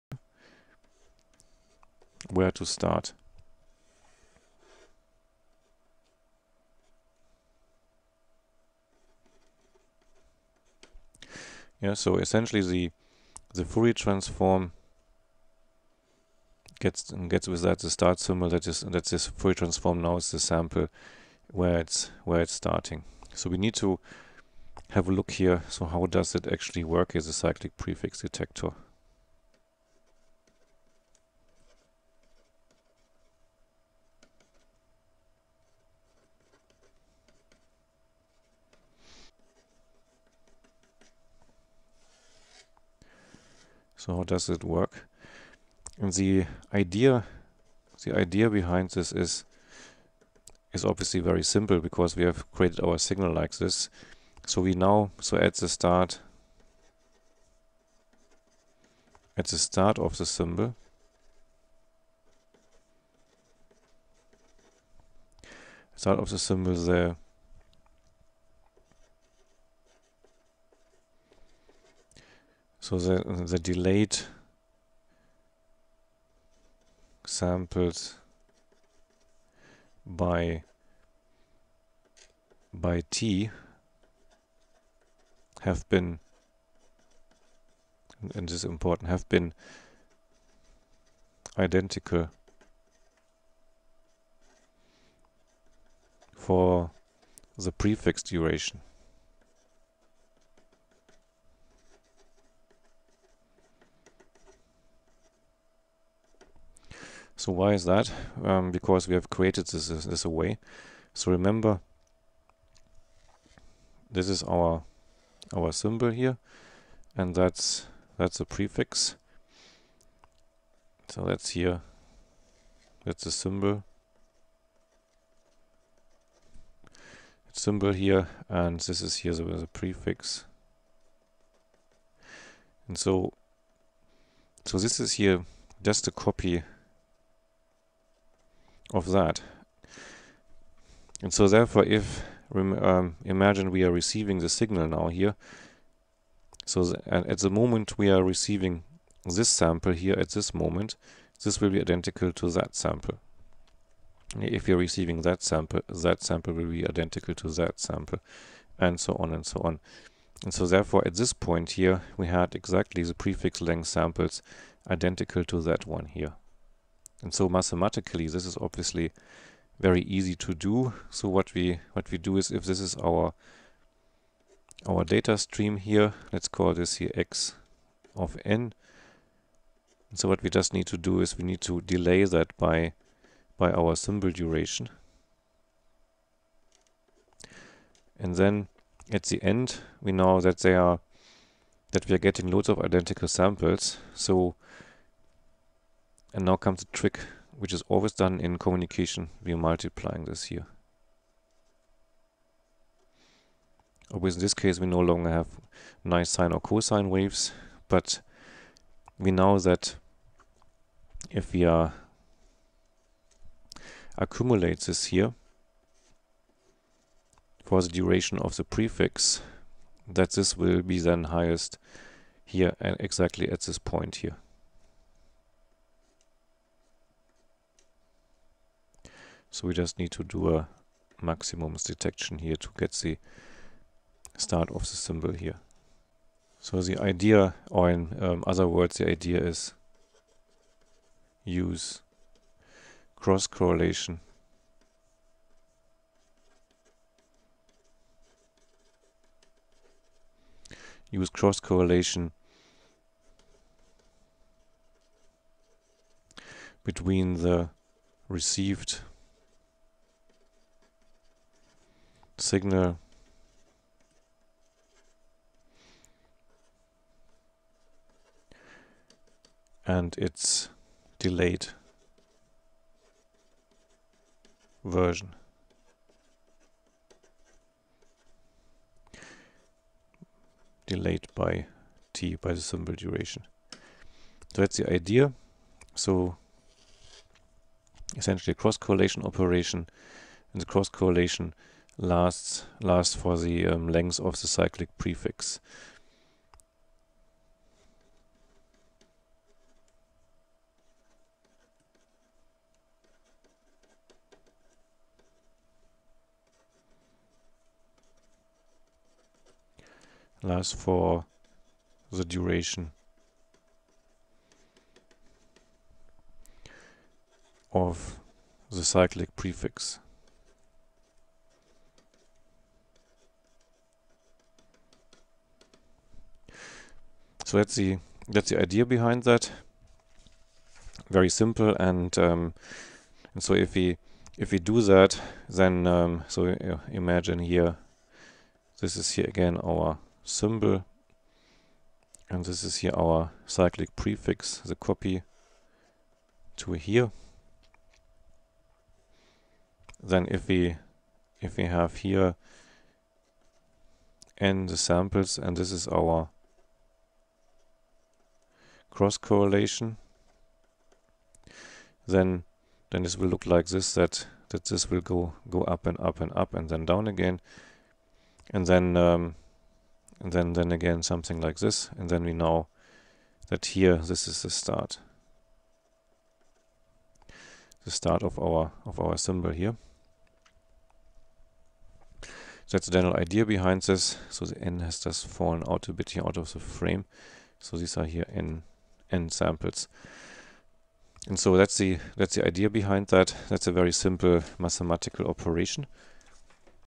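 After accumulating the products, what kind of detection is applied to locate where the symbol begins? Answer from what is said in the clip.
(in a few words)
maximums detection.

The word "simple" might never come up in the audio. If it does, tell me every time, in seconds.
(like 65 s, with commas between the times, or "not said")
51 s, 331 s, 393 s.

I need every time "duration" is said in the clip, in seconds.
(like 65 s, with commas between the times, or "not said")
98 s, 184 s, 217 s, 282 s, 312 s.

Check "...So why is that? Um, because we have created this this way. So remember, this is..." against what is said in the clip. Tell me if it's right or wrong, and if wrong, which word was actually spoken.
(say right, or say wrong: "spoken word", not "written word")
right.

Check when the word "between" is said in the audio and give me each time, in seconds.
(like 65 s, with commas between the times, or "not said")
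256 s.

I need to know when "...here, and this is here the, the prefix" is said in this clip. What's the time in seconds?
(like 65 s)
127 s.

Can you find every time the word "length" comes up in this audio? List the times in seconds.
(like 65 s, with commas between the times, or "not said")
163 s, 293 s.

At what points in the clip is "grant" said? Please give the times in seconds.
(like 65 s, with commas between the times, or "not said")
not said.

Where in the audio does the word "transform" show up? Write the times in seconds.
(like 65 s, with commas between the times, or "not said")
13 s, 19 s.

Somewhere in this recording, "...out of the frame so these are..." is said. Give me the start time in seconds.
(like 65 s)
386 s.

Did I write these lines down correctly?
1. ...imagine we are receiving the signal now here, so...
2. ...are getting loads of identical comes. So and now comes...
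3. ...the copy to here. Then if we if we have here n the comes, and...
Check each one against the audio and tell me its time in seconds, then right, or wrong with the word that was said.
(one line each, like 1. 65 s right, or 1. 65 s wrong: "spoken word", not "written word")
1. 143 s right
2. 192 s wrong: "samples", not "comes"
3. 344 s wrong: "samples", not "comes".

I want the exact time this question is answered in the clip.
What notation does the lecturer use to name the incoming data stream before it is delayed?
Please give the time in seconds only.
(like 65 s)
177 s.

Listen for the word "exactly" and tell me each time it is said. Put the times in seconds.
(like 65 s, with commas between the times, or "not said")
162 s, 222 s.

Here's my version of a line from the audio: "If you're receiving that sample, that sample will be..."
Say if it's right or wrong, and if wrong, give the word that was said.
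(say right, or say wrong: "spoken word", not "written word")
right.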